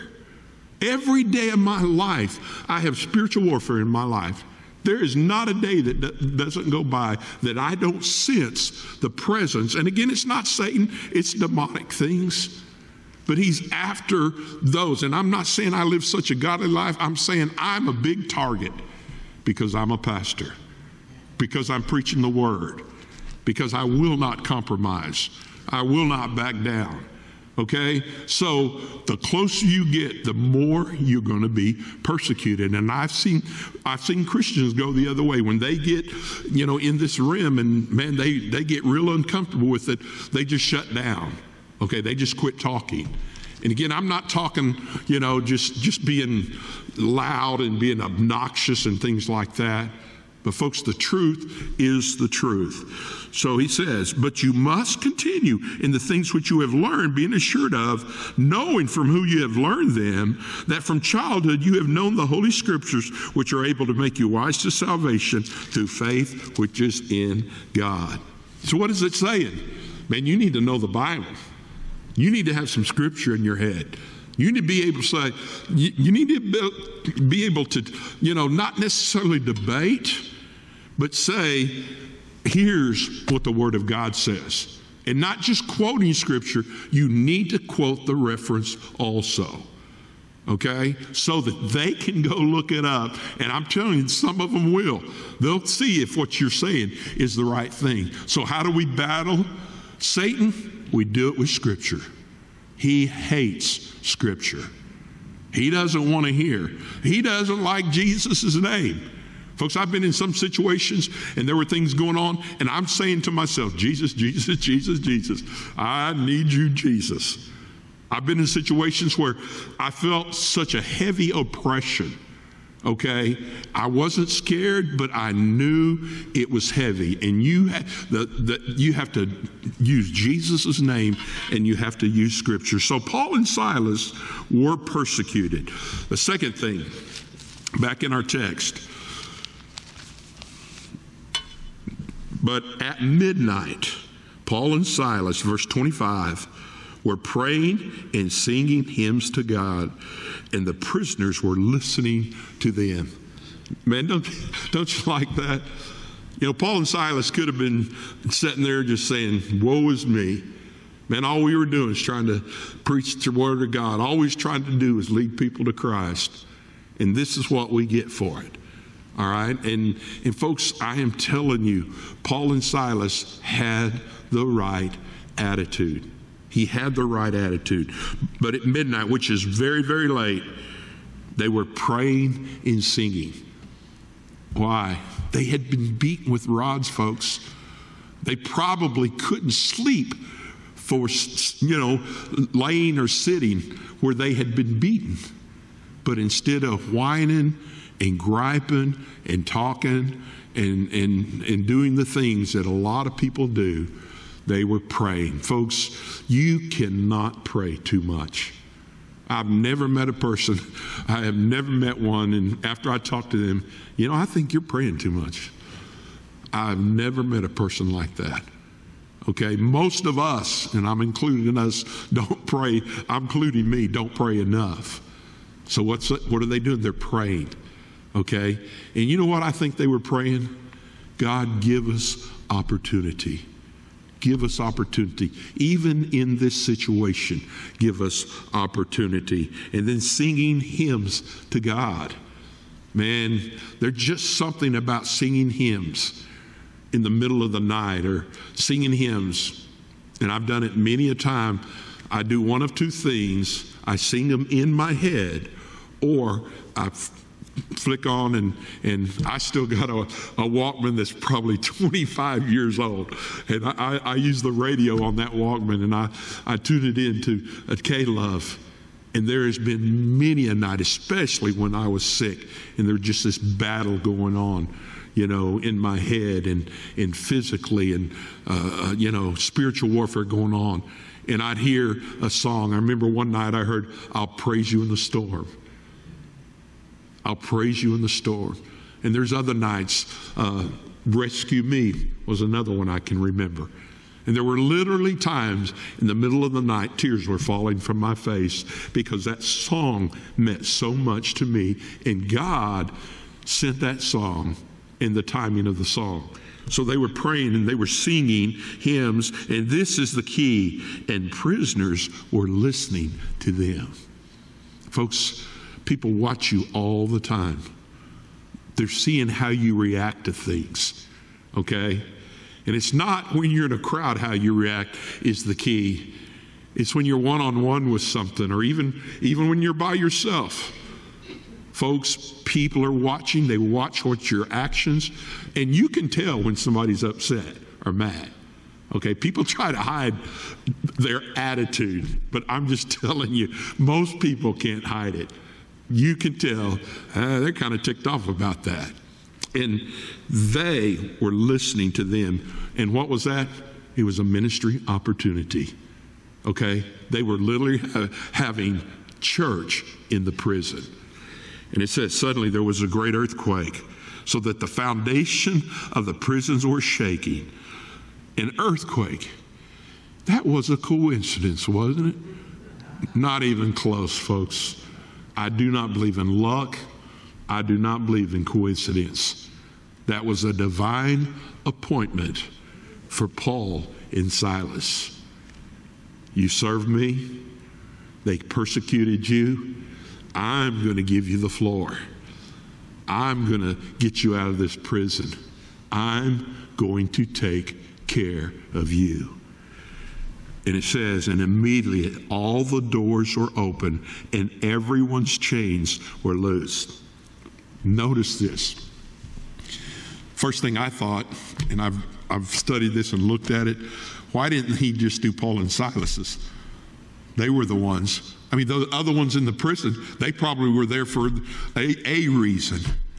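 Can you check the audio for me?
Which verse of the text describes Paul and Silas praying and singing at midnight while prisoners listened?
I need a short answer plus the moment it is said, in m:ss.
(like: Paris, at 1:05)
Verse 25, at 2:25.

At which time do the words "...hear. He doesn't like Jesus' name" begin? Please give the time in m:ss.
1:46.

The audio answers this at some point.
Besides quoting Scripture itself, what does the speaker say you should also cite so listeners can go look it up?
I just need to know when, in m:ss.
1:28.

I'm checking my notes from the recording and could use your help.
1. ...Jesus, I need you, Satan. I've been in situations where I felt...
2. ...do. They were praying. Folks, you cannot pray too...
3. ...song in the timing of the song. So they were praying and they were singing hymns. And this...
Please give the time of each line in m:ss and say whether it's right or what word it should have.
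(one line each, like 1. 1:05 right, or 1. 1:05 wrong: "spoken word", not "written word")
1. 1:54 wrong: "Jesus", not "Satan"
2. 3:23 right
3. 5:04 right.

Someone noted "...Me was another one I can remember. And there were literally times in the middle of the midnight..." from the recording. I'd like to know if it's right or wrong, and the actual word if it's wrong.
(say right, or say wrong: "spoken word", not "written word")
wrong: "night", not "midnight".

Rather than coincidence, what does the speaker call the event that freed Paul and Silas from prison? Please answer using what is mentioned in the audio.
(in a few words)
A divine appointment.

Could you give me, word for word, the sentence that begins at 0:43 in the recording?
And again, I'm not talking, you know, just just being loud and being obnoxious and things like that.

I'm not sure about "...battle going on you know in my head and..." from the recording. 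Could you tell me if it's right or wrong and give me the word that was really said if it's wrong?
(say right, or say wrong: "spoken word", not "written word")
right.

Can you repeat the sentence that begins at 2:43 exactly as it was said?
Always trying to do is lead people to Christ.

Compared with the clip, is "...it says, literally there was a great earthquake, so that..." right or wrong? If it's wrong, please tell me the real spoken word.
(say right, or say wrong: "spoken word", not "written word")
wrong: "suddenly", not "literally".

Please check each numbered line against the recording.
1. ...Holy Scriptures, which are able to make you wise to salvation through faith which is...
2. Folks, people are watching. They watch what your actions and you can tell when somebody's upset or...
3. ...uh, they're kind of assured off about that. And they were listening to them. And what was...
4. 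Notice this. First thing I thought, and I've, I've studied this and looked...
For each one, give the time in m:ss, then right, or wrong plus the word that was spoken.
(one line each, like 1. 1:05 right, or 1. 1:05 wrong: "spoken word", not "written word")
1. 1:02 right
2. 5:31 right
3. 5:47 wrong: "ticked", not "assured"
4. 6:47 right.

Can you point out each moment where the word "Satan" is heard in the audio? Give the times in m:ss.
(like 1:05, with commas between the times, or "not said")
0:10, 1:39.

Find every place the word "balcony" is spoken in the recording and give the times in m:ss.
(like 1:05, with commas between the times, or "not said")
not said.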